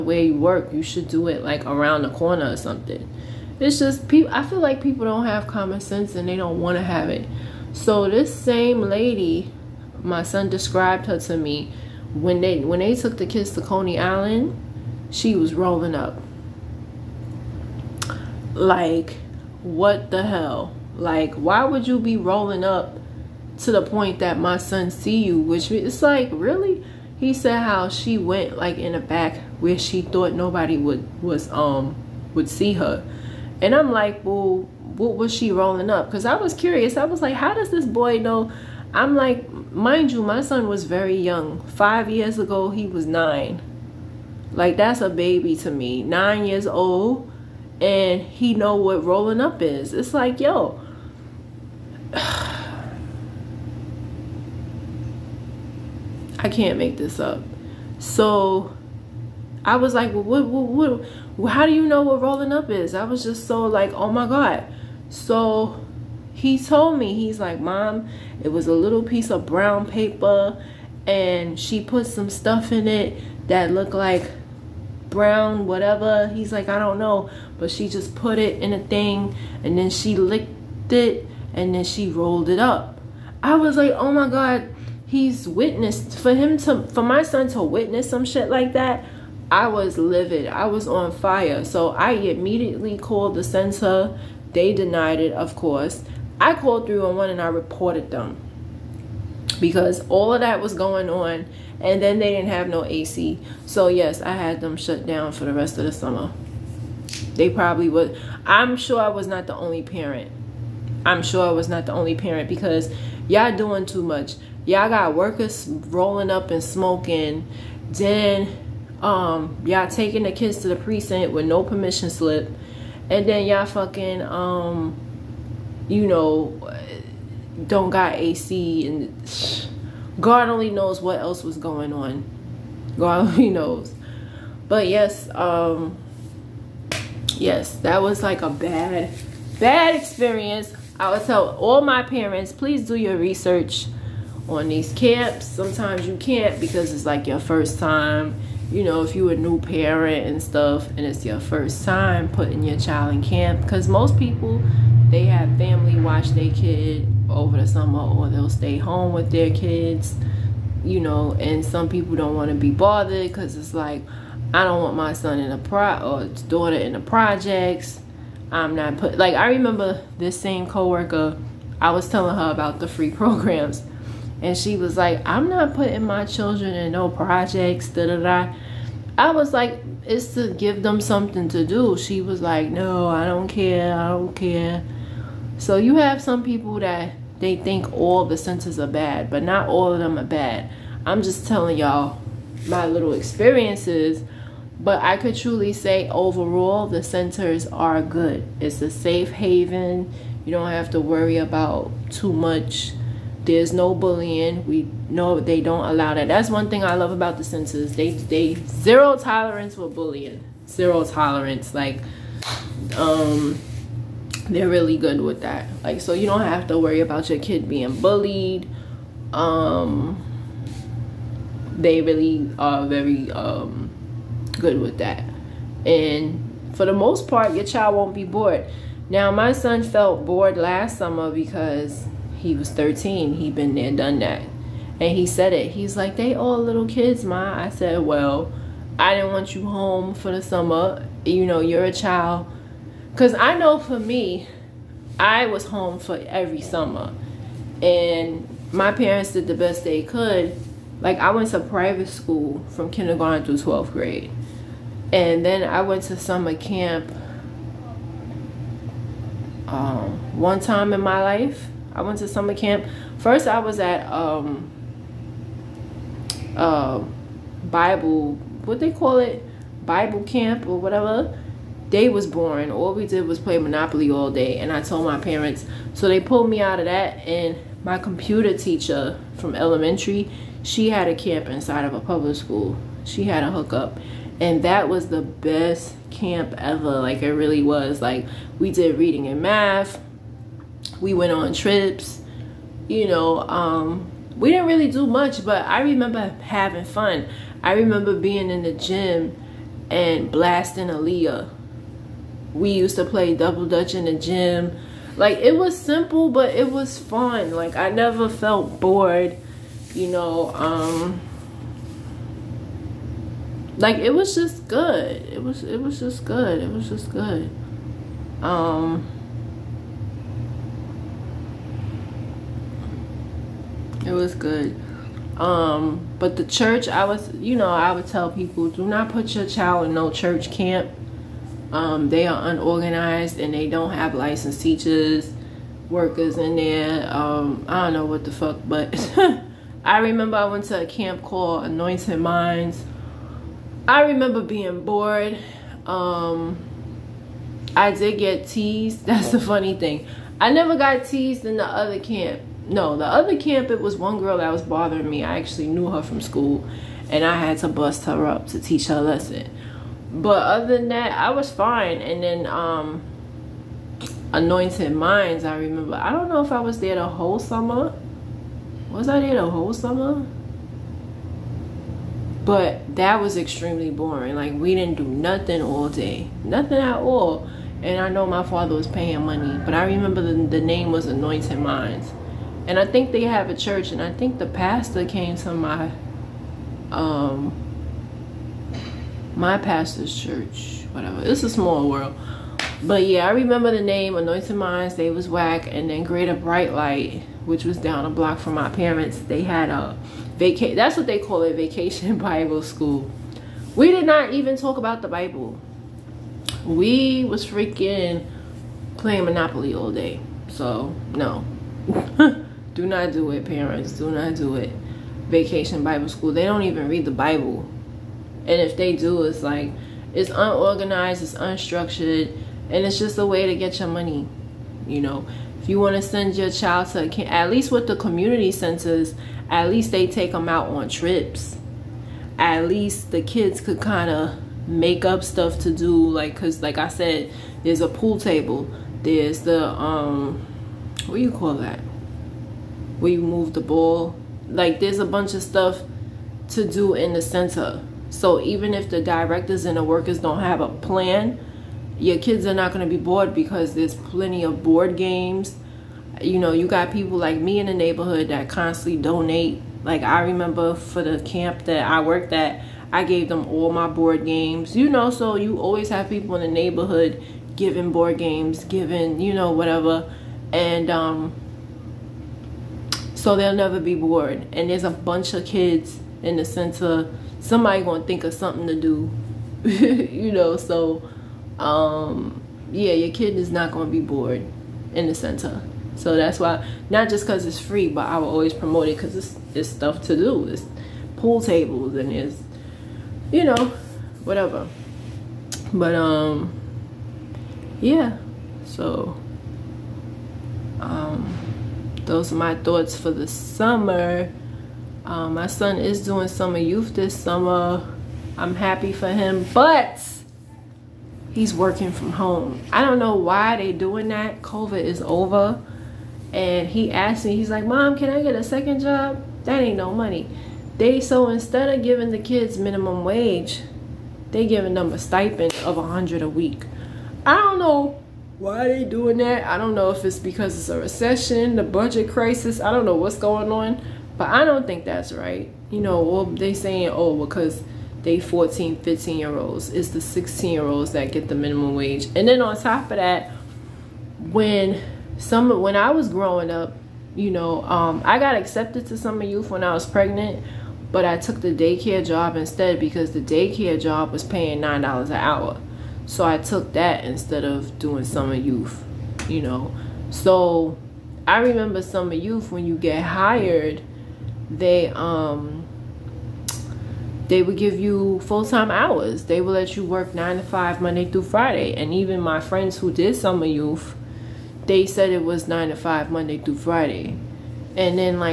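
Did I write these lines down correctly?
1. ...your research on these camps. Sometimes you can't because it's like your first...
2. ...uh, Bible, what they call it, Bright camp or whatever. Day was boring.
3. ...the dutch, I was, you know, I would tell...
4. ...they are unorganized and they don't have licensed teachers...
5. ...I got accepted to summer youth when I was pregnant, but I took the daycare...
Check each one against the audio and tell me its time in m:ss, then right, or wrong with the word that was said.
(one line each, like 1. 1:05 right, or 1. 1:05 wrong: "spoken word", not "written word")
1. 2:22 right
2. 4:26 wrong: "Bible", not "Bright"
3. 5:26 wrong: "church", not "dutch"
4. 5:32 right
5. 9:08 right.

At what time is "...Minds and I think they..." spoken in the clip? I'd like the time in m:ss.
6:21.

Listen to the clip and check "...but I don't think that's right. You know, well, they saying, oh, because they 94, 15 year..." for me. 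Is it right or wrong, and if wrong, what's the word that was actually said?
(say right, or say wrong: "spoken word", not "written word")
wrong: "14", not "94".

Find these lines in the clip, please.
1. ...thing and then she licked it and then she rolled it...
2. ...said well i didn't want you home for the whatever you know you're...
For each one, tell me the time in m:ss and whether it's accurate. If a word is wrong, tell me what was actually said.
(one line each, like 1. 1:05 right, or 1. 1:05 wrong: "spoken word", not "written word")
1. 1:18 right
2. 3:57 wrong: "summer", not "whatever".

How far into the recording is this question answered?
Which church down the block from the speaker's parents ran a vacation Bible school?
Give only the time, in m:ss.
6:36.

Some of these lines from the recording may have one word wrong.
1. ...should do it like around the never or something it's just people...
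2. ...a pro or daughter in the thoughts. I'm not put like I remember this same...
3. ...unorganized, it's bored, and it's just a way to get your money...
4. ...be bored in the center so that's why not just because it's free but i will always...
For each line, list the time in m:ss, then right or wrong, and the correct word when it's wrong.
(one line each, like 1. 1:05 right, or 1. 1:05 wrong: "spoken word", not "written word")
1. 0:00 wrong: "corner", not "never"
2. 2:45 wrong: "projects", not "thoughts"
3. 7:00 wrong: "unstructured", not "bored"
4. 8:03 right.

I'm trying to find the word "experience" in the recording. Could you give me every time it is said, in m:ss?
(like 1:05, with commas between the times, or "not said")
2:19, 3:13.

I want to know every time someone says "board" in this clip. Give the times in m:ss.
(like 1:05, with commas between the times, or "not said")
7:34, 7:43, 7:47.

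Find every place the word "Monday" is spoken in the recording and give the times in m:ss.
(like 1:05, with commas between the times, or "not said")
9:30, 9:36.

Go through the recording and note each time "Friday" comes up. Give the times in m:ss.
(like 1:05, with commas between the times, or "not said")
9:31, 9:36.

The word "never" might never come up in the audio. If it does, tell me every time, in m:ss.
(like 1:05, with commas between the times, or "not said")
5:07, 5:50, 7:53.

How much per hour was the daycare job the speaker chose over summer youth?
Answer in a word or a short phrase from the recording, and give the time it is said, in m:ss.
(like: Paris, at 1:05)
$9, at 9:14.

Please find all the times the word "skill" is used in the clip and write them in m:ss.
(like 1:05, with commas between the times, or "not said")
not said.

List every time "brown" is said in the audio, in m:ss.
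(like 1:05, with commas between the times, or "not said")
1:09, 1:15.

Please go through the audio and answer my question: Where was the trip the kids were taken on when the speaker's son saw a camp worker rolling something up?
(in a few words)
Coney Island.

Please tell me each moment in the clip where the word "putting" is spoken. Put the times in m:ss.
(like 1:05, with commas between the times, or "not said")
2:32, 2:55.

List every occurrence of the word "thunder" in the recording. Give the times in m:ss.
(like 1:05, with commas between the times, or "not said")
not said.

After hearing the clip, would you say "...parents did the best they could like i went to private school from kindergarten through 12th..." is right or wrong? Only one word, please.
right.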